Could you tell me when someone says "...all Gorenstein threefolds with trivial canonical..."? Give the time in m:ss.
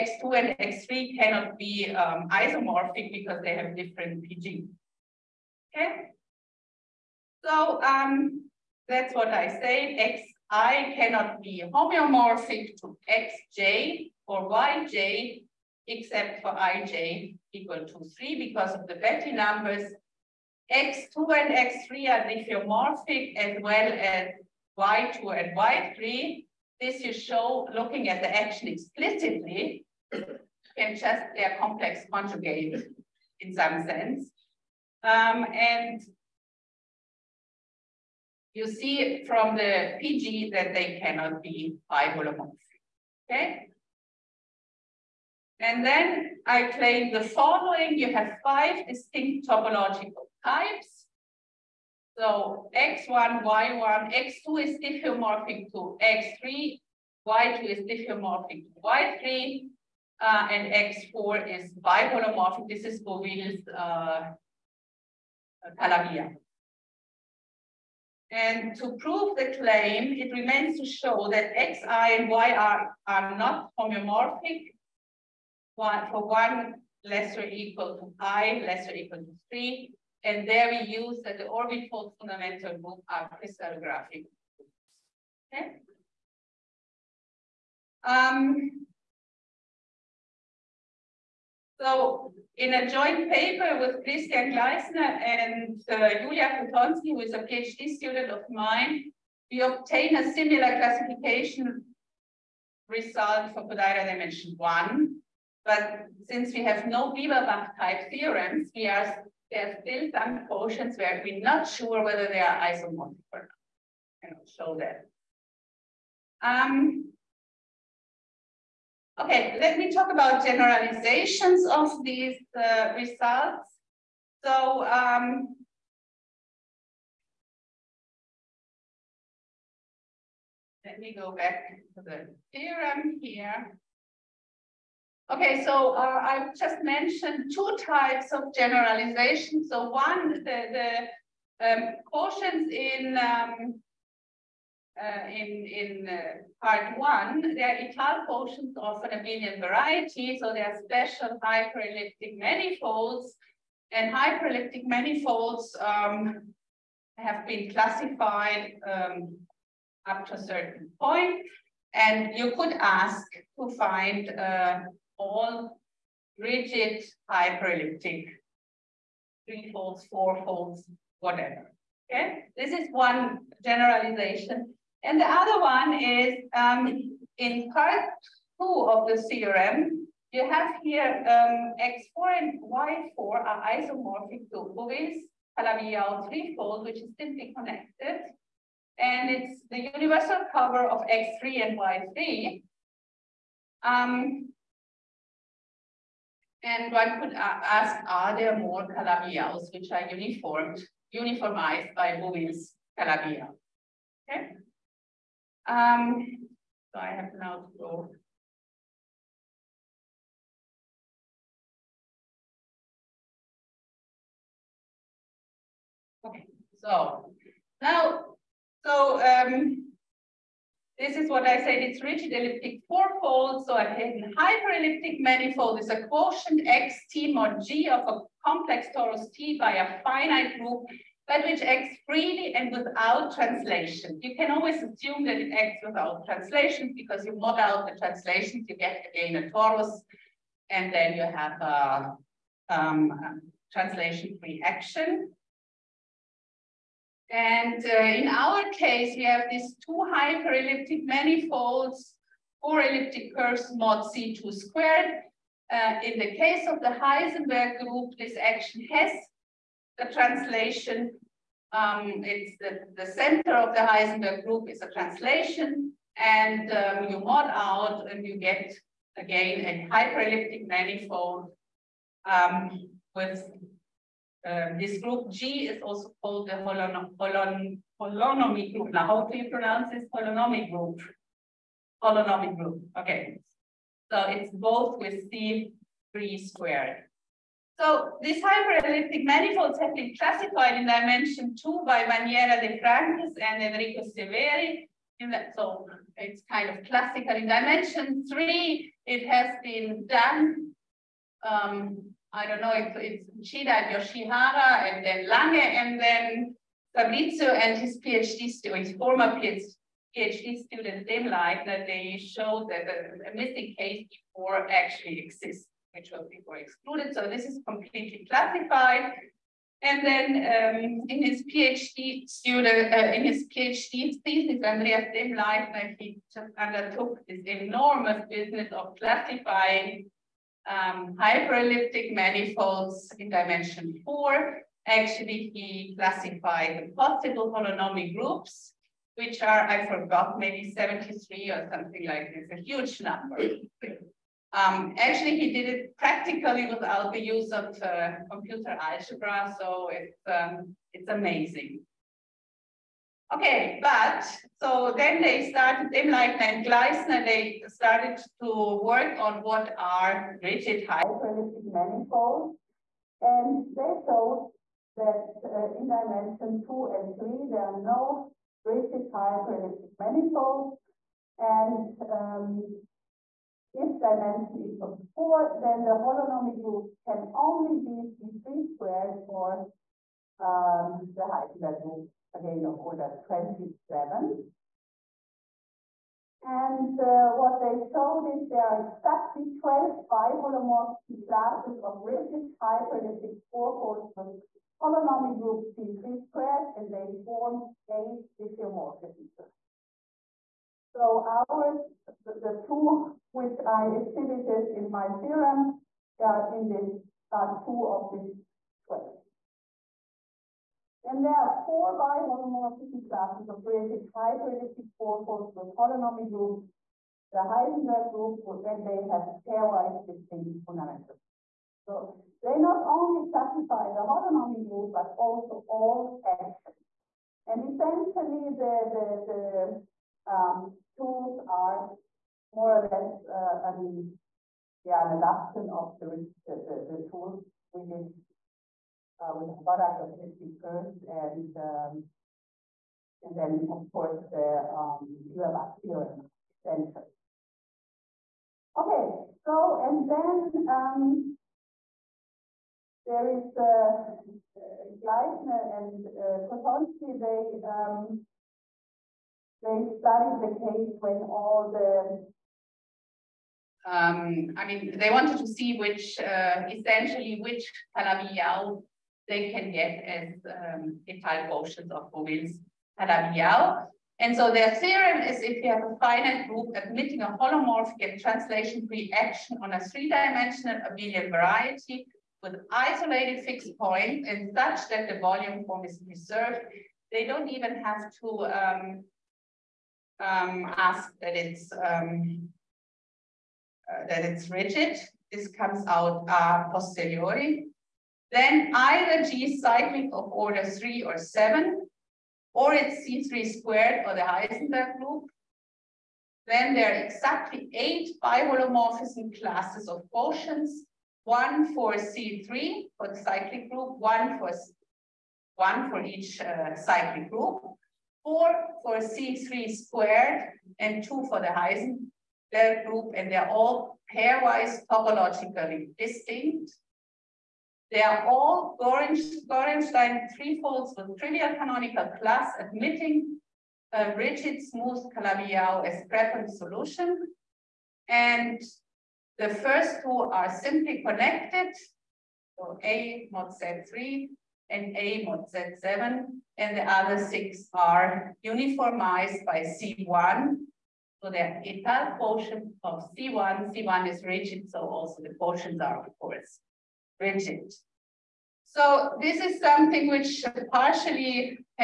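8:48.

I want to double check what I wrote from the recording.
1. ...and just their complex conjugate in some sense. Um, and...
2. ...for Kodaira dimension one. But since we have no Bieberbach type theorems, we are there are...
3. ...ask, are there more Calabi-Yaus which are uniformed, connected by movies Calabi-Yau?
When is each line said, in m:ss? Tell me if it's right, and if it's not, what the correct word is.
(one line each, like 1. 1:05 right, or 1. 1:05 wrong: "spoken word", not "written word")
1. 0:30 right
2. 1:43 right
3. 3:17 wrong: "uniformized", not "connected".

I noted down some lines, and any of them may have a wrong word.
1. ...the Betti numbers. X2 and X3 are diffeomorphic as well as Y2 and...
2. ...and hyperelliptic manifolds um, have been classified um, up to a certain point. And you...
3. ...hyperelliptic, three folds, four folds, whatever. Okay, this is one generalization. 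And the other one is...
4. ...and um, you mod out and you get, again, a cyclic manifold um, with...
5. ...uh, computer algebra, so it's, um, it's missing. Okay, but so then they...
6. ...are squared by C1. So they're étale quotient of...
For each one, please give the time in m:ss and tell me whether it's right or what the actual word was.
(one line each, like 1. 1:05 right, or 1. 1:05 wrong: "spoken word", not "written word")
1. 0:18 right
2. 2:33 right
3. 2:47 right
4. 4:26 wrong: "hyperelliptic", not "cyclic"
5. 5:47 wrong: "amazing", not "missing"
6. 9:07 wrong: "uniformized", not "squared".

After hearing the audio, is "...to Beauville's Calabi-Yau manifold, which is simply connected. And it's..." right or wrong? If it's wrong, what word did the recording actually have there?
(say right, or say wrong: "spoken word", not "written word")
wrong: "threefold", not "manifold".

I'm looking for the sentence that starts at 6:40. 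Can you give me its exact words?
So ours, the, the, two which I exhibited in my theorem are in this, are two of these 12.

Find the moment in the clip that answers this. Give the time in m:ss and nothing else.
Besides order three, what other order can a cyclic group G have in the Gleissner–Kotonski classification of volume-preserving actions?
8:21.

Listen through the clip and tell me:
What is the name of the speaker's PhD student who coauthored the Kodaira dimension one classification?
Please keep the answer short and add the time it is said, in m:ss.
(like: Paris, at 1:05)
Julia Kotonski, at 1:36.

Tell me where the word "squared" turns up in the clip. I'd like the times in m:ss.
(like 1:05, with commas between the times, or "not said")
4:14, 4:46, 6:18, 6:36, 8:23, 8:39.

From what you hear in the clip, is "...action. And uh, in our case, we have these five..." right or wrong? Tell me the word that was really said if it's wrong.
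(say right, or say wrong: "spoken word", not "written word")
wrong: "two", not "five".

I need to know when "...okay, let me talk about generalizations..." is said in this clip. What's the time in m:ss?
1:59.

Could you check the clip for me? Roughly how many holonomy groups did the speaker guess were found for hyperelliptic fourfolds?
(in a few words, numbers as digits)
73.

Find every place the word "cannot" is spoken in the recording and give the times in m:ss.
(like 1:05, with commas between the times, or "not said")
0:01, 0:10, 0:41.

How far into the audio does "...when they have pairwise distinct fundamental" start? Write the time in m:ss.
6:58.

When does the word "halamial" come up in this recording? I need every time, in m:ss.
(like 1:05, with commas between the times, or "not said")
7:52.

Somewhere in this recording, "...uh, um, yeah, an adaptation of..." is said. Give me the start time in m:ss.
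7:13.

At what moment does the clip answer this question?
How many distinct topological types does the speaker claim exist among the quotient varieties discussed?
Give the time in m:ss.
0:48.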